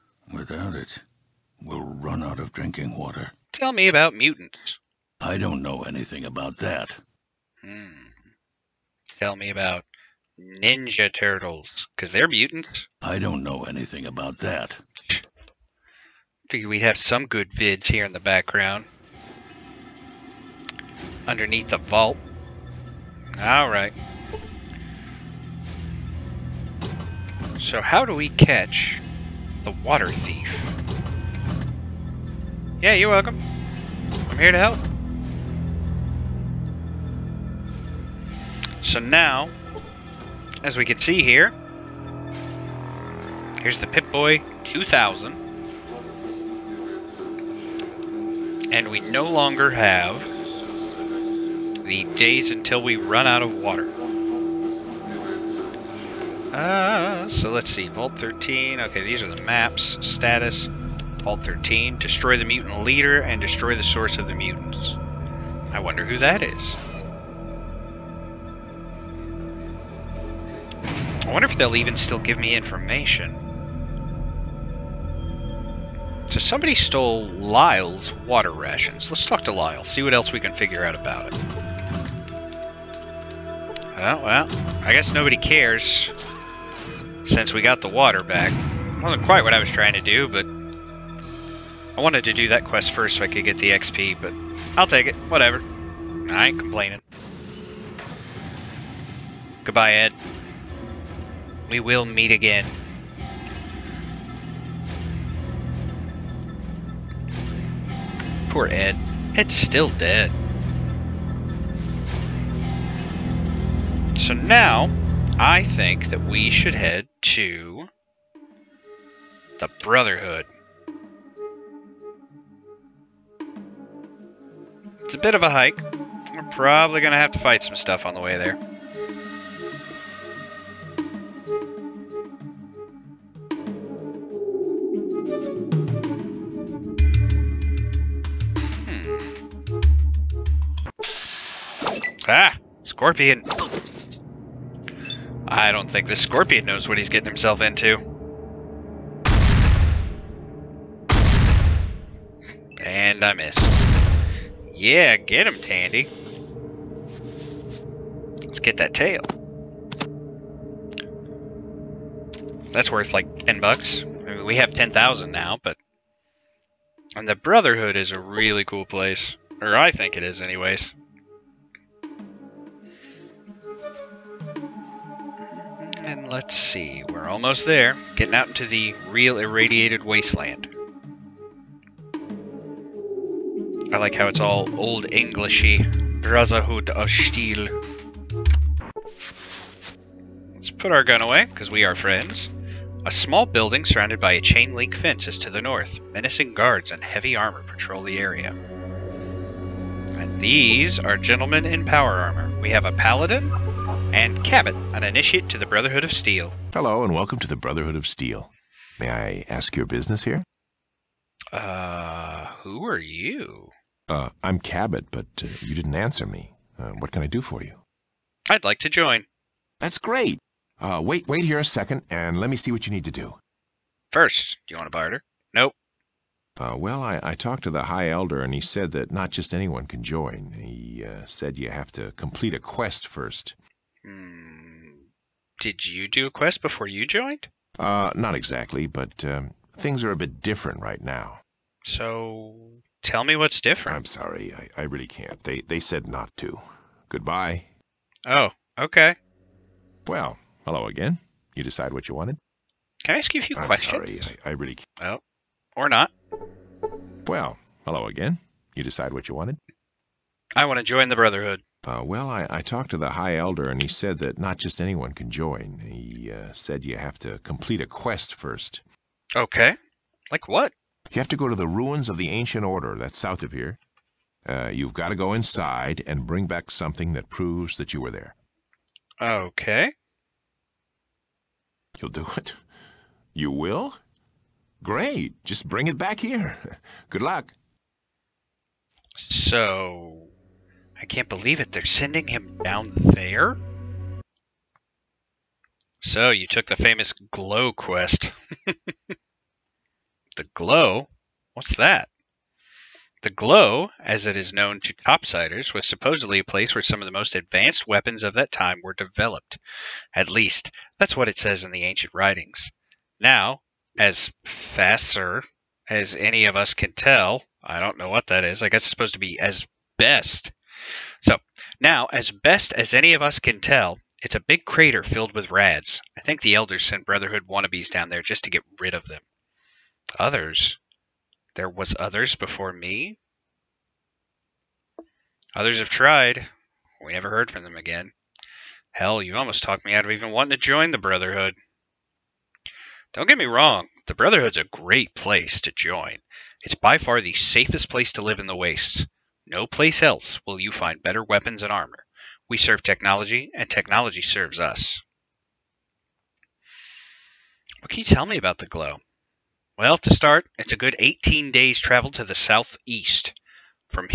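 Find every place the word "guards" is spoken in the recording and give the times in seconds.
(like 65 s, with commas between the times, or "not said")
196 s.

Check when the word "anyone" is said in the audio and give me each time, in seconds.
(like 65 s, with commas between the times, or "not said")
229 s, 264 s.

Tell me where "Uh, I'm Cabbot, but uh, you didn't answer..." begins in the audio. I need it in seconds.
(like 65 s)
214 s.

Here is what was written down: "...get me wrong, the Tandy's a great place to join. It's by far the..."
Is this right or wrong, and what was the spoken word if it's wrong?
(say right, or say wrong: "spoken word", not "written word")
wrong: "Brotherhood", not "Tandy".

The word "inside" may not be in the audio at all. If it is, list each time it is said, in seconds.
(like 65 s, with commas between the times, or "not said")
275 s.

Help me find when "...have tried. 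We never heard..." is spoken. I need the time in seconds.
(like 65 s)
335 s.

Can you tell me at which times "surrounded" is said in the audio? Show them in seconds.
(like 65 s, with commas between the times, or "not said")
193 s.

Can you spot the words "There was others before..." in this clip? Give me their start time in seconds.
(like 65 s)
331 s.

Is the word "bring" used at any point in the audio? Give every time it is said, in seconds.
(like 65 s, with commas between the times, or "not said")
276 s, 285 s.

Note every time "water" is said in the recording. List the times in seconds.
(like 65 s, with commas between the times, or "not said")
2 s, 29 s, 53 s, 78 s, 87 s.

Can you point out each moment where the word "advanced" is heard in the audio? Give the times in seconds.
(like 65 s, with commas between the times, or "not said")
307 s.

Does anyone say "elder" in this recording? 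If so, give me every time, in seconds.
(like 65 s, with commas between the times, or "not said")
228 s, 263 s, 326 s.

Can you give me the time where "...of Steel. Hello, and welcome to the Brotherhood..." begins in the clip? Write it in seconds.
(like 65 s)
206 s.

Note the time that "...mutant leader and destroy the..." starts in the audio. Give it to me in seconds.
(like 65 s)
62 s.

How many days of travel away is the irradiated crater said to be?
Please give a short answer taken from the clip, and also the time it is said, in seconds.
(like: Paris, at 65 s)
18, at 360 s.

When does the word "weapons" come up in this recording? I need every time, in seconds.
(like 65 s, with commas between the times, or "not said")
307 s, 351 s.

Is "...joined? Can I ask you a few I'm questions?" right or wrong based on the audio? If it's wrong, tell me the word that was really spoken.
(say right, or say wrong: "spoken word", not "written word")
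wrong: "wanted", not "joined".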